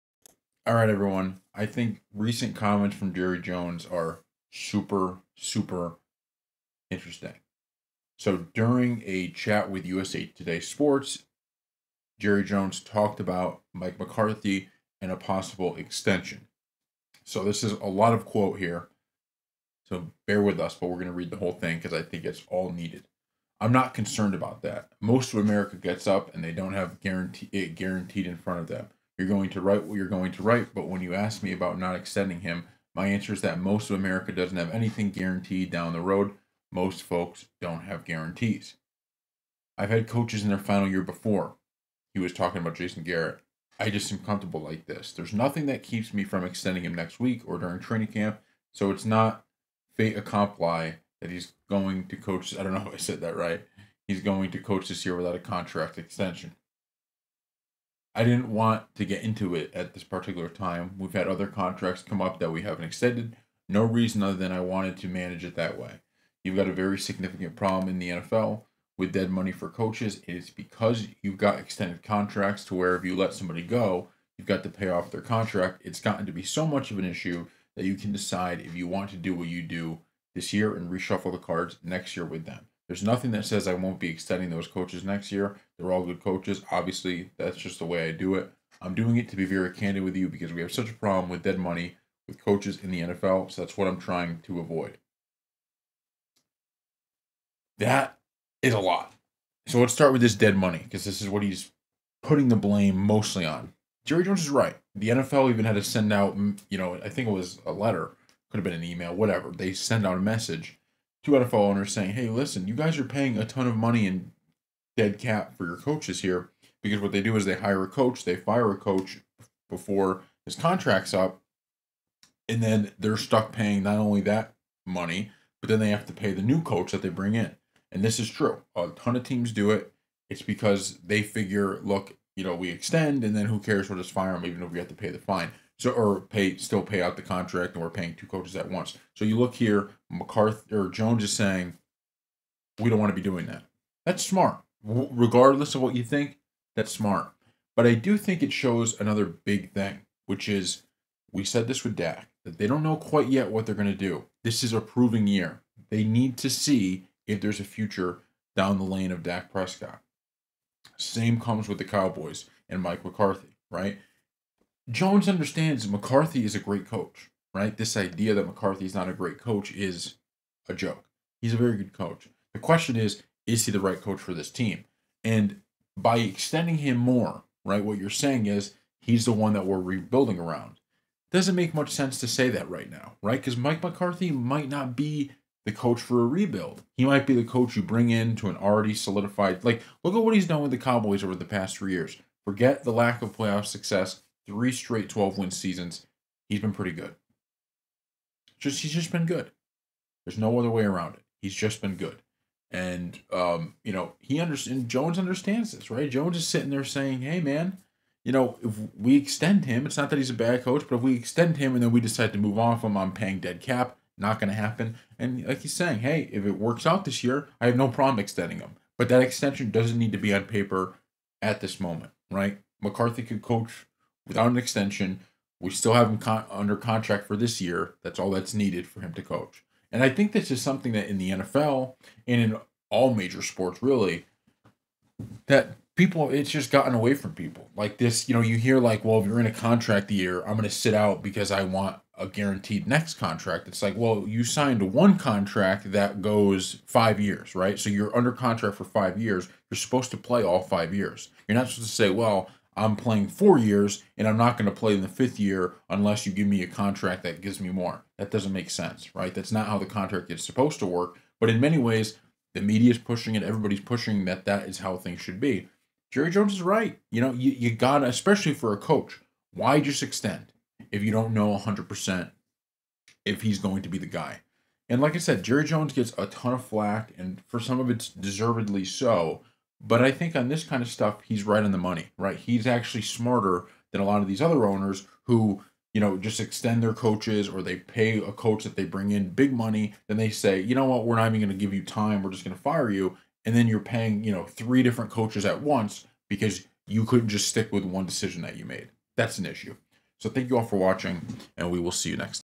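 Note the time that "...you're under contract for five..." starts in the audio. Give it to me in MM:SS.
04:07.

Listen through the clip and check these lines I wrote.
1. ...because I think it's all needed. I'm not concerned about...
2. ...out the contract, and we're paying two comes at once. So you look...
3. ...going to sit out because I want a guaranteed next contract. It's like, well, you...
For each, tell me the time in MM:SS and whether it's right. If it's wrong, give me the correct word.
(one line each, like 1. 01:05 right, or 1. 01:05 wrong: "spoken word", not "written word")
1. 00:21 right
2. 02:17 wrong: "coaches", not "comes"
3. 04:00 right.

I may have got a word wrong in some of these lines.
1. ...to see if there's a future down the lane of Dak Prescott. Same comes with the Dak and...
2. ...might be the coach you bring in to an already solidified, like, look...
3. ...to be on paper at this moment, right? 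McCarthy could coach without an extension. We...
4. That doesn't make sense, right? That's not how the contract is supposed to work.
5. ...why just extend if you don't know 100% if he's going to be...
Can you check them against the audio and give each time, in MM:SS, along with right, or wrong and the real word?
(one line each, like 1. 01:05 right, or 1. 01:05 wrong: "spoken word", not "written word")
1. 02:36 wrong: "Cowboys", not "Dak"
2. 03:07 right
3. 03:40 right
4. 04:18 right
5. 04:29 right.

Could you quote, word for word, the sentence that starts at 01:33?
So that's what I'm trying to avoid.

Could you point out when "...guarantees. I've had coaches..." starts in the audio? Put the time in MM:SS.
00:38.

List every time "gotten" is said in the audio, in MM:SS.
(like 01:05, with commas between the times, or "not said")
01:16, 03:56.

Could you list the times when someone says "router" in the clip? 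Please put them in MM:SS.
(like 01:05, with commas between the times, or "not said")
not said.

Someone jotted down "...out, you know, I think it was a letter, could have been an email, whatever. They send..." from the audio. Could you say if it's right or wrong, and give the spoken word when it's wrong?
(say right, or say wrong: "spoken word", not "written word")
right.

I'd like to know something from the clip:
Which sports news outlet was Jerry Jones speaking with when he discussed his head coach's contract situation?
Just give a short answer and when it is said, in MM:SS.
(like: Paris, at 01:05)
USA Today Sports, at 00:09.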